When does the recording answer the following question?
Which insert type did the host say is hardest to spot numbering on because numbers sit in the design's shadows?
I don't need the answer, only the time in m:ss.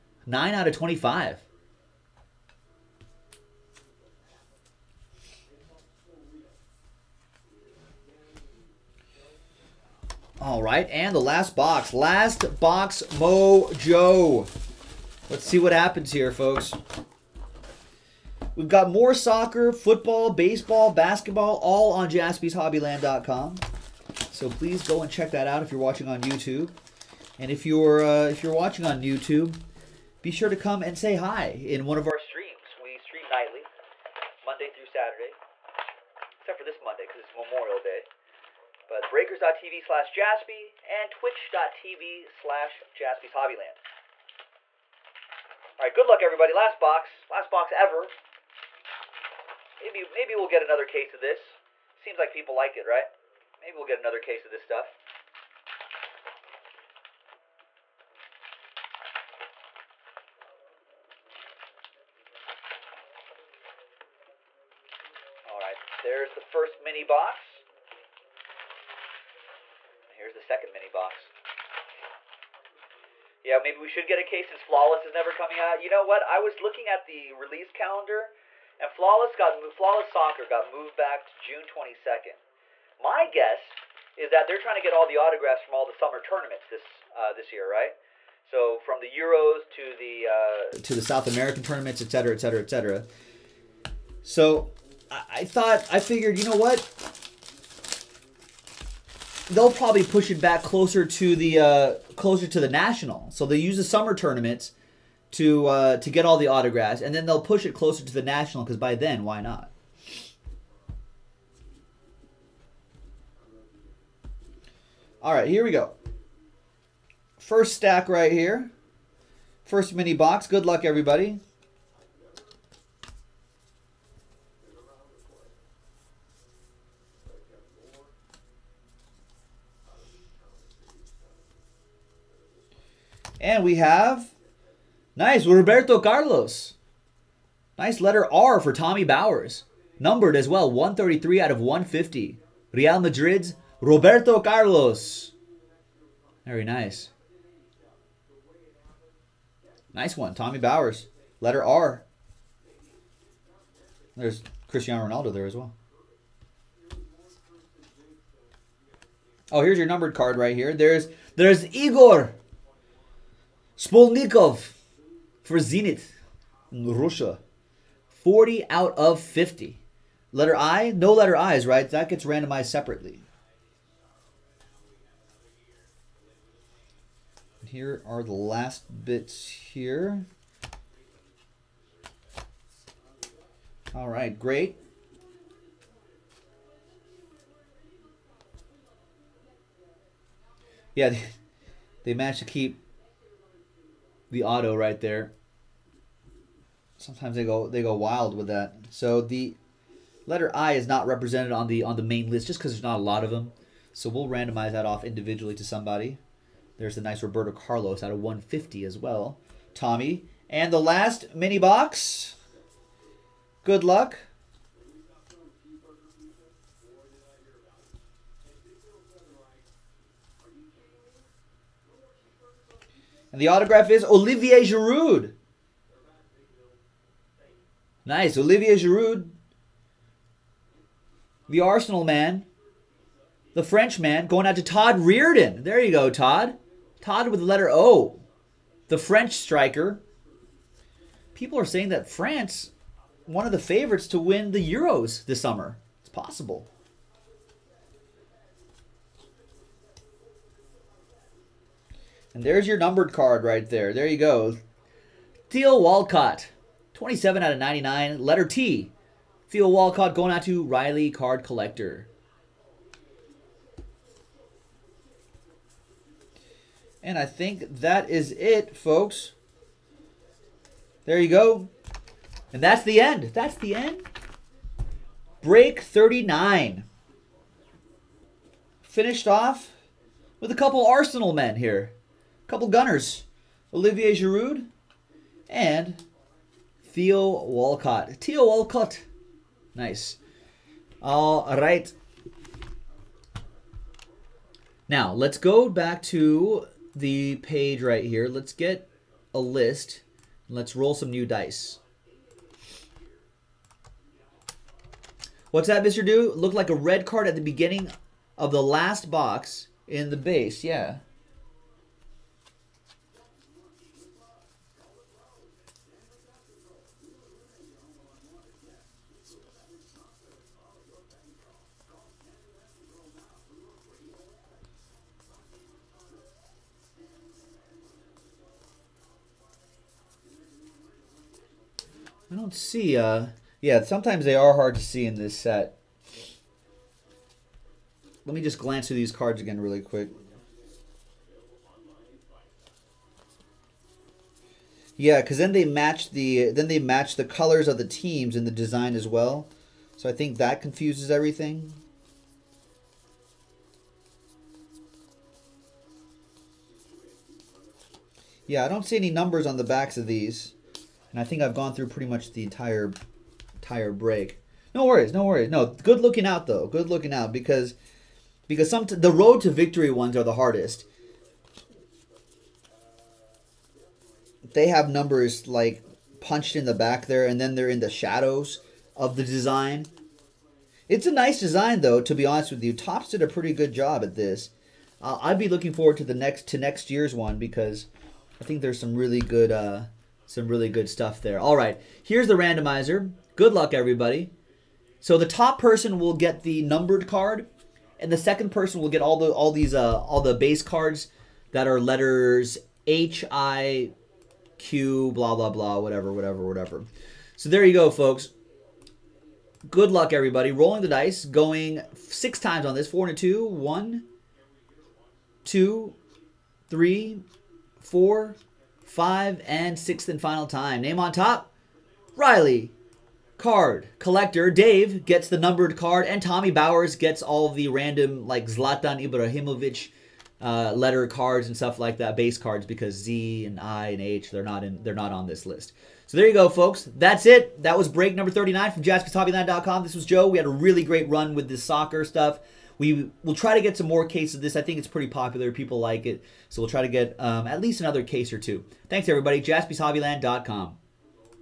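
6:09.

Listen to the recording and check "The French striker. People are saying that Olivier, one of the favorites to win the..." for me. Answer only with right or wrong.
wrong.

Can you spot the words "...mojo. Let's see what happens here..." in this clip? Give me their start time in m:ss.
0:13.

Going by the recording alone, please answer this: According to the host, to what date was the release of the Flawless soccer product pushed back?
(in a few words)
June 22nd.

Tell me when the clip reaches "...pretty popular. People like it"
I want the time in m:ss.
7:24.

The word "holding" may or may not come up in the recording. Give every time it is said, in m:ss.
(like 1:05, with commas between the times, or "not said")
not said.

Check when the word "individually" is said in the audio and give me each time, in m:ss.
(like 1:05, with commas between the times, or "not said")
3:25.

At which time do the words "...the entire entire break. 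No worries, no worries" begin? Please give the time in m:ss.
6:02.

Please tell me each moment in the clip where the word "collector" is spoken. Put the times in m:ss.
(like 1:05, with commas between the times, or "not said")
4:21, 7:03.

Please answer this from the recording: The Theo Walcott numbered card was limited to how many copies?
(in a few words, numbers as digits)
99.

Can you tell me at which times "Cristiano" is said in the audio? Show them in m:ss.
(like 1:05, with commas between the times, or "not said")
2:34.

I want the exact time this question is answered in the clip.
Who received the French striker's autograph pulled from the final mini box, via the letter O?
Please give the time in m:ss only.
3:54.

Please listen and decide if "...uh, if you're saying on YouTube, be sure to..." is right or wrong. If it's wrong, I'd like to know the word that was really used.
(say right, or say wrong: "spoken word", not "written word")
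wrong: "watching", not "saying".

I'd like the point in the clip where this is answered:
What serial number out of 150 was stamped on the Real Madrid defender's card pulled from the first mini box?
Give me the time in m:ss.
2:20.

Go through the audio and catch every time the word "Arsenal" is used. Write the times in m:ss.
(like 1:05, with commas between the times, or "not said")
3:51, 4:40.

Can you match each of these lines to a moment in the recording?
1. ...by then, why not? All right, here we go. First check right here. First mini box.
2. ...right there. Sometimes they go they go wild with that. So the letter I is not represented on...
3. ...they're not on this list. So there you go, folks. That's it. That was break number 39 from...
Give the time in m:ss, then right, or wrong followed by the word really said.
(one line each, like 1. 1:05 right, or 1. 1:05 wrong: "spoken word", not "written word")
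1. 1:48 wrong: "stack", not "check"
2. 3:14 right
3. 7:14 right.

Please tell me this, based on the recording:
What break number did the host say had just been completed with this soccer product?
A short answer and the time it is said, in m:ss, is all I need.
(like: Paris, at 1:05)
39, at 4:35.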